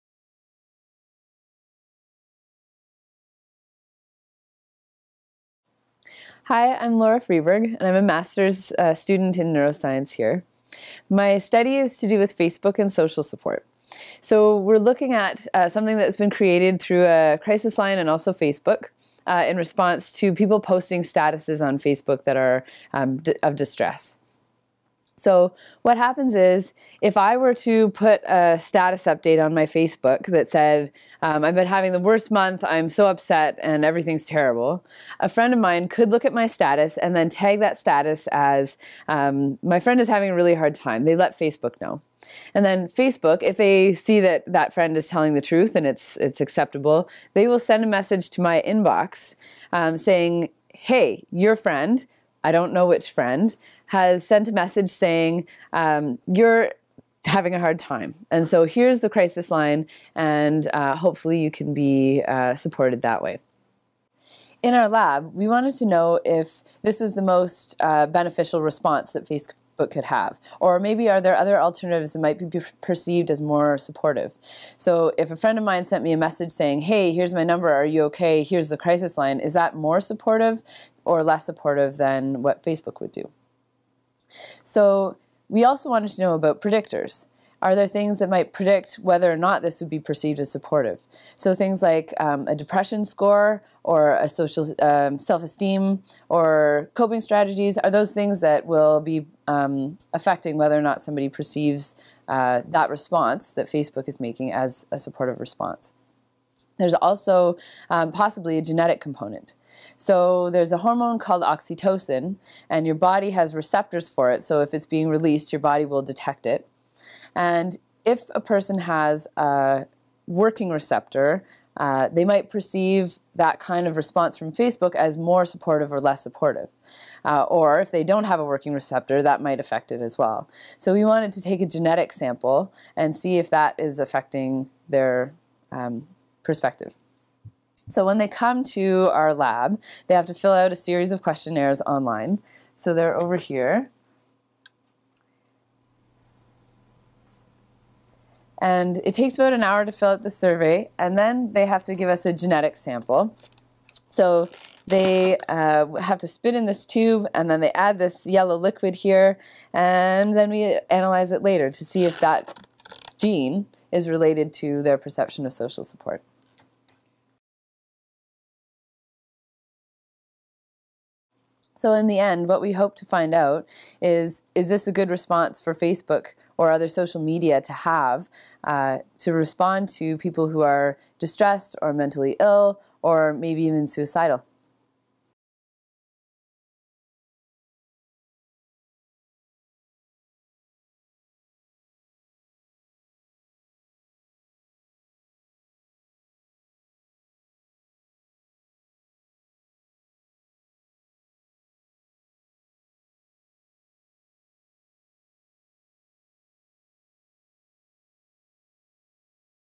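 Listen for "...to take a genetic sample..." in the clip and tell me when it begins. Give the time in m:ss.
2:11.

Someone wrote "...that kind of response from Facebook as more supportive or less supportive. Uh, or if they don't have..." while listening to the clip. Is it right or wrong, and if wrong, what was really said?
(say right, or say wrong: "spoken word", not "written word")
right.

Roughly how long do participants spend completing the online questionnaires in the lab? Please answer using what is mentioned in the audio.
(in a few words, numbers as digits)
about an hour.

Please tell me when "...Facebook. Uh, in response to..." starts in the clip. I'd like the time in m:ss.
0:18.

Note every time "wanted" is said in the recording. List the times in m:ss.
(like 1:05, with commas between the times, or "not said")
1:05, 1:25, 2:11.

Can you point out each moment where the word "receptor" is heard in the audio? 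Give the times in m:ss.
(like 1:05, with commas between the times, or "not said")
1:53, 2:00, 2:08.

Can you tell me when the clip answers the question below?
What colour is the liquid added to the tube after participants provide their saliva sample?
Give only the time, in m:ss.
2:38.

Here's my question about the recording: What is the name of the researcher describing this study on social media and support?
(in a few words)
Laura Friberg.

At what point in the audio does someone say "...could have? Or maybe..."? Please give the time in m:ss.
1:09.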